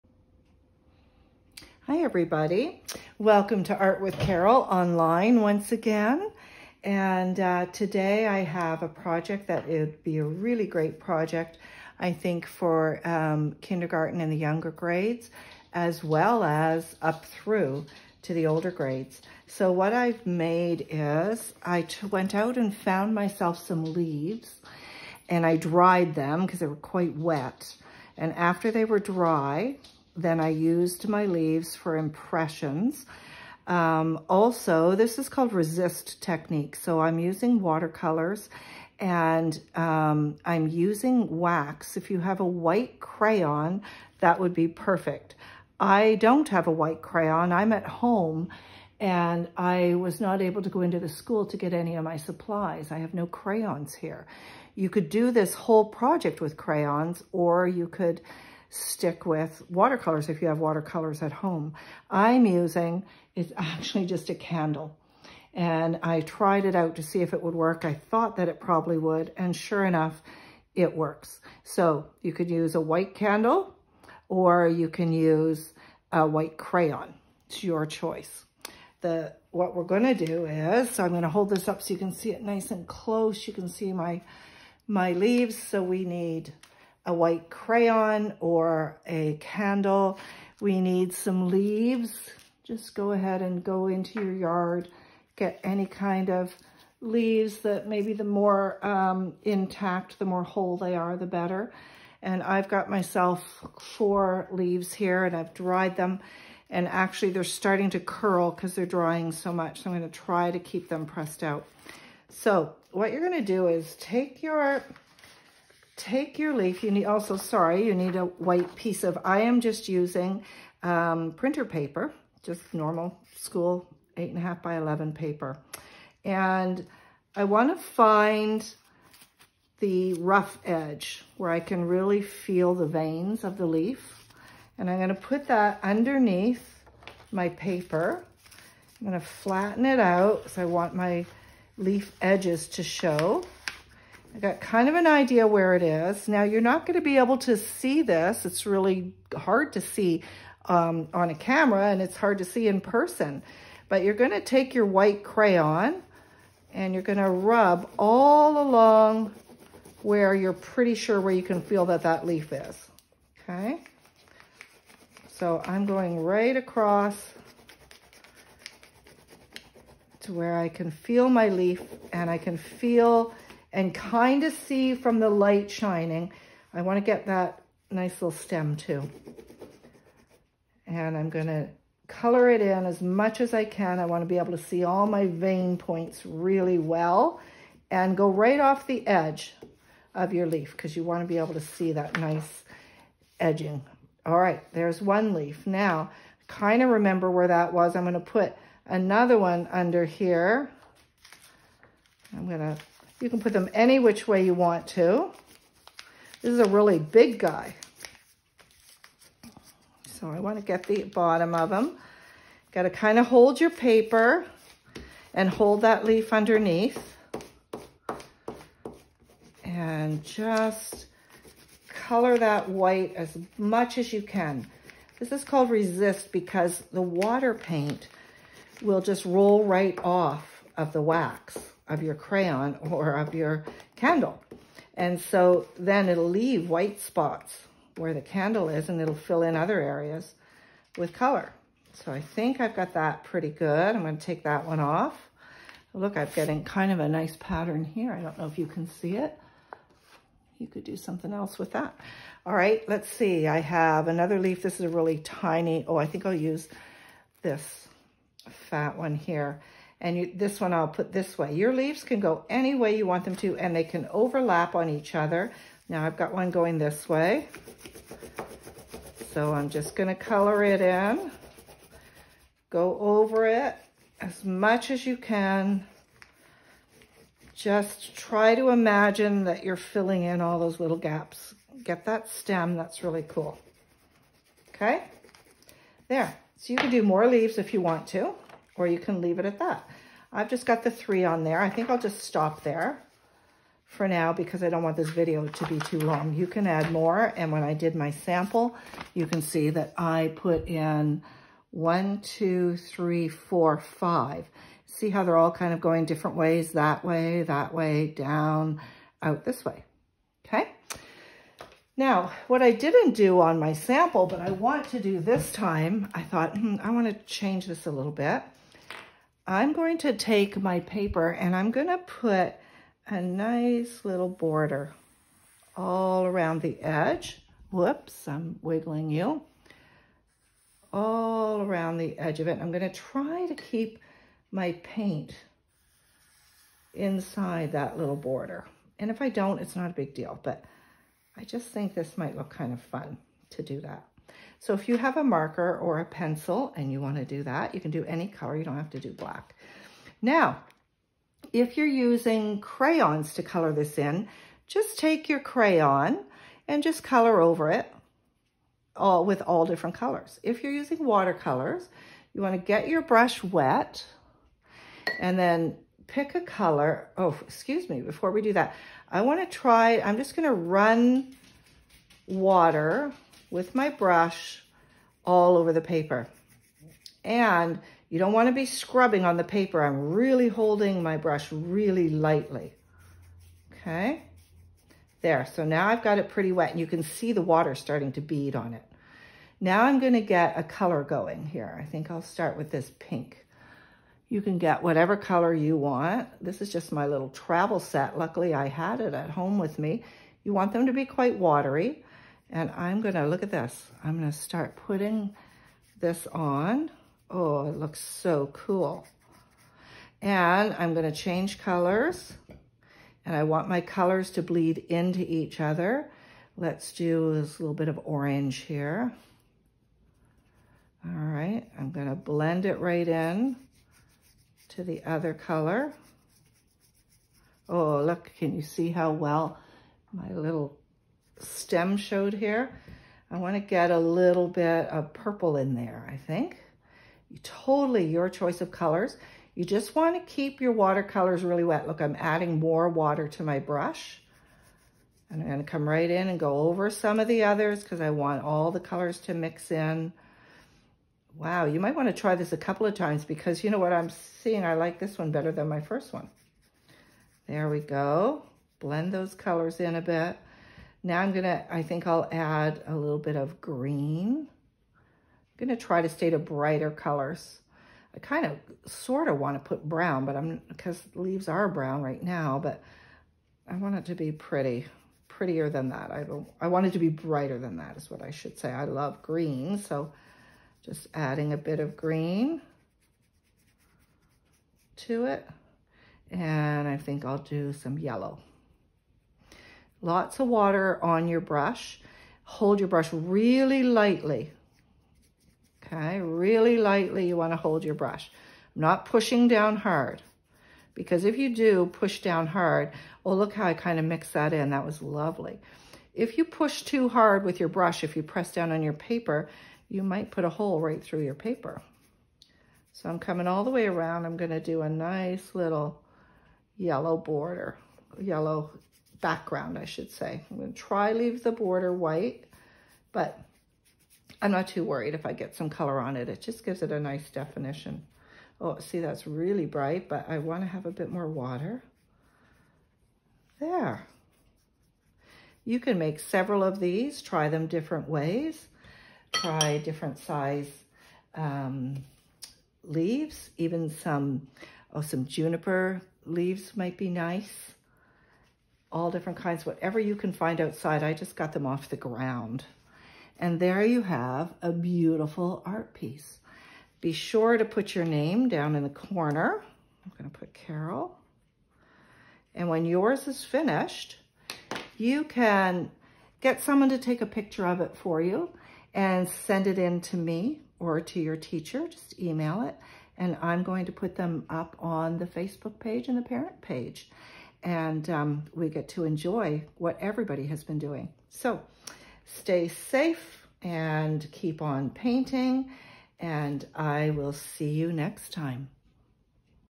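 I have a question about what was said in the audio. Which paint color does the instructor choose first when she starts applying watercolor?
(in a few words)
Pink.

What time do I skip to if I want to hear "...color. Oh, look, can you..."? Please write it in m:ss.
7:05.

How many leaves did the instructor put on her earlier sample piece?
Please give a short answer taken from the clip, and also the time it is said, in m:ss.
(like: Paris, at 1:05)
5, at 5:03.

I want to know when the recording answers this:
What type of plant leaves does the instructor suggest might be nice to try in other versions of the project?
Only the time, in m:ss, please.
9:05.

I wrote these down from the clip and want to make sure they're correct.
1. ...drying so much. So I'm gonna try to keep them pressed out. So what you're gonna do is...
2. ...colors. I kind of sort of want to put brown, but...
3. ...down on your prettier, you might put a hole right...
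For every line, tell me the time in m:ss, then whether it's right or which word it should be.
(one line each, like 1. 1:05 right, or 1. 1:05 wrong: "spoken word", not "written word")
1. 1:48 right
2. 7:46 right
3. 8:28 wrong: "paper", not "prettier".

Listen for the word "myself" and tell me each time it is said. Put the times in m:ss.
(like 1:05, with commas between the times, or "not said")
0:23, 1:42.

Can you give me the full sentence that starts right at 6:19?
I'm really holding my brush really lightly.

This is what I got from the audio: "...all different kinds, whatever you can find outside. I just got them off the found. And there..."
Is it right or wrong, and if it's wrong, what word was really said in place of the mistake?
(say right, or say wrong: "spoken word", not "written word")
wrong: "ground", not "found".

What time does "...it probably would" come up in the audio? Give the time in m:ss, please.
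1:08.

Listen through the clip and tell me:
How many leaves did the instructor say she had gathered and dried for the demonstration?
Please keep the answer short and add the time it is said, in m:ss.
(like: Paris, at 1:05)
4, at 1:43.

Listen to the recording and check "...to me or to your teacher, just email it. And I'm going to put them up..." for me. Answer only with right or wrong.
right.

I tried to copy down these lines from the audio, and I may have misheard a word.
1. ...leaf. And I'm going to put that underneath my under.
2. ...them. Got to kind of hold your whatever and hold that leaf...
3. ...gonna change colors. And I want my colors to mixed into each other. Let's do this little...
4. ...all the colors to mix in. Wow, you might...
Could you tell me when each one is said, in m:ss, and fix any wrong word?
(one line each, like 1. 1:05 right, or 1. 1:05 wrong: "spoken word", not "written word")
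1. 2:13 wrong: "paper", not "under"
2. 3:31 wrong: "paper", not "whatever"
3. 6:50 wrong: "bleed", not "mixed"
4. 7:28 right.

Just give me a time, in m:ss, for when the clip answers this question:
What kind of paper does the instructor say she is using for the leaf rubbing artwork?
2:01.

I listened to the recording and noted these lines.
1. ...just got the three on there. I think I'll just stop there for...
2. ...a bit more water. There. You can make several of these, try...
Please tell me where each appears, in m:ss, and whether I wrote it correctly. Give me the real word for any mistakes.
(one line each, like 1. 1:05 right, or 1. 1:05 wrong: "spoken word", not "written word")
1. 4:50 right
2. 8:50 right.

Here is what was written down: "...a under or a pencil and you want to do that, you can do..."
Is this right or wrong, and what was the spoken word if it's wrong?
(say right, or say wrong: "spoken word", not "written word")
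wrong: "marker", not "under".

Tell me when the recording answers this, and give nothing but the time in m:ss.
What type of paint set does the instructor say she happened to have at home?
6:37.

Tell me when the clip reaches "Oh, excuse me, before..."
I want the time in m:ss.
6:07.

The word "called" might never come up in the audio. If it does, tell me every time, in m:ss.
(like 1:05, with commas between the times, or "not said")
0:35, 3:45.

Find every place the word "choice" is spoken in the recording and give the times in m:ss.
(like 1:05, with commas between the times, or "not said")
1:17, 7:18.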